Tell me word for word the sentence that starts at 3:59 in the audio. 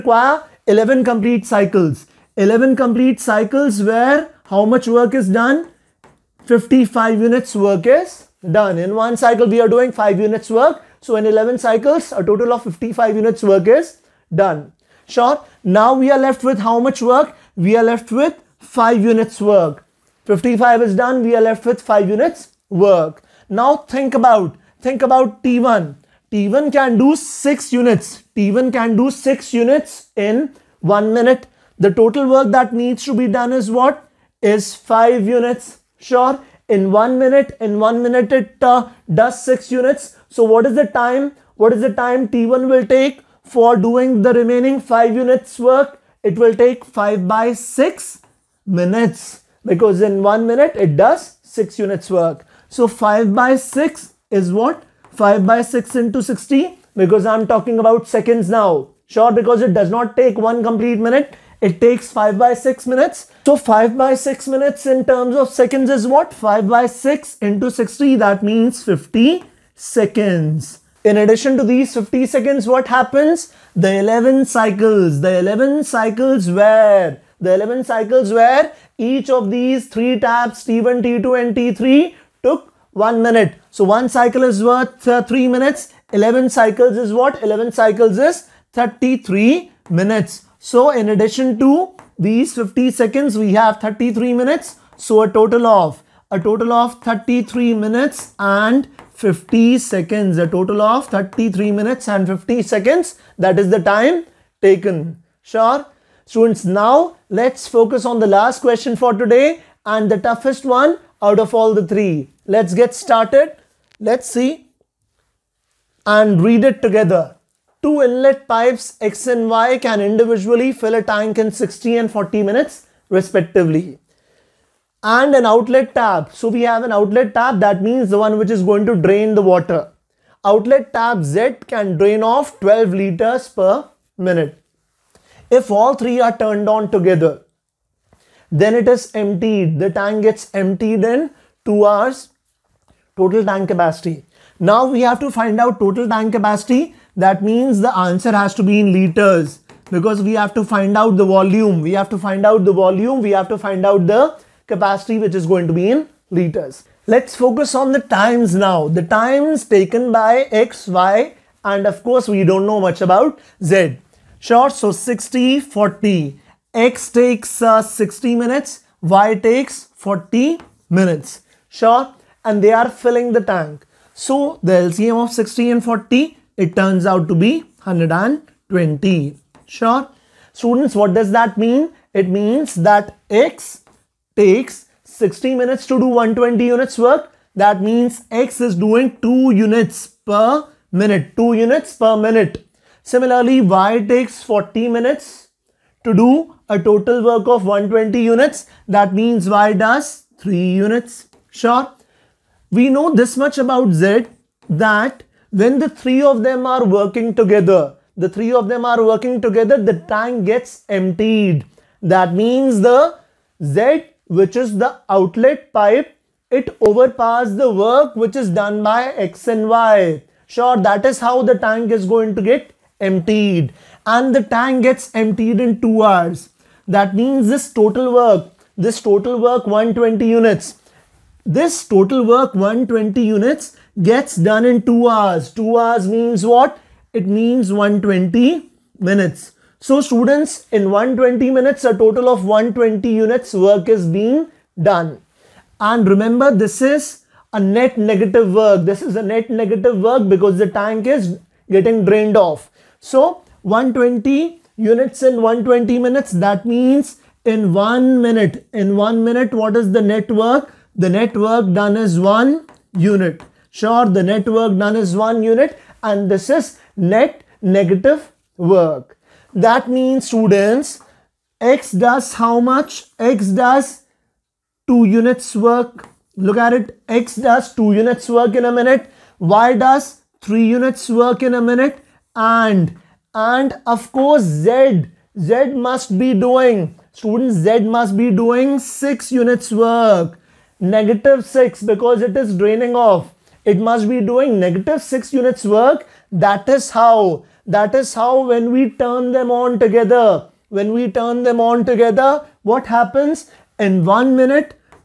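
So students, in 120 minutes, a total of 120 units work is being done.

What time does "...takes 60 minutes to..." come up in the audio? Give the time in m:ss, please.
3:04.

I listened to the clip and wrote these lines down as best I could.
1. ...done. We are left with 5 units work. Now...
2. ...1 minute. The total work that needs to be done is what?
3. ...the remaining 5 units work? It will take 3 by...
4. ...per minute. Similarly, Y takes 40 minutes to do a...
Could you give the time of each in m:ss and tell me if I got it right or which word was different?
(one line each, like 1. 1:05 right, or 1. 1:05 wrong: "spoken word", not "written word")
1. 0:20 right
2. 0:30 right
3. 0:44 wrong: "5", not "3"
4. 3:11 right.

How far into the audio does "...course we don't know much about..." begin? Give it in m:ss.
2:42.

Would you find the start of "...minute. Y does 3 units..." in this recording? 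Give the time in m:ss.
4:38.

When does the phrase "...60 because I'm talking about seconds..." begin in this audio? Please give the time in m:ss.
0:56.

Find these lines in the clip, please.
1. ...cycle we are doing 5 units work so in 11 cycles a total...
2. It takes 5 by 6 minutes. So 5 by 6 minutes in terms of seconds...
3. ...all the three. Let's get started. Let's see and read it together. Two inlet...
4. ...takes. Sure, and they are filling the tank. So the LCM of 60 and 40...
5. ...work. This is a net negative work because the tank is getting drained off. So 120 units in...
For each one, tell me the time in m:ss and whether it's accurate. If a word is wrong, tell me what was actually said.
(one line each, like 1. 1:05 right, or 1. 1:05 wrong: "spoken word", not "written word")
1. 0:09 right
2. 1:01 right
3. 1:51 right
4. 2:50 wrong: "minutes", not "takes"
5. 4:08 right.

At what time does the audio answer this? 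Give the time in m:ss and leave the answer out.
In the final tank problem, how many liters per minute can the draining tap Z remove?
2:12.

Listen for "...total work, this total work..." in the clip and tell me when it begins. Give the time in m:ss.
3:47.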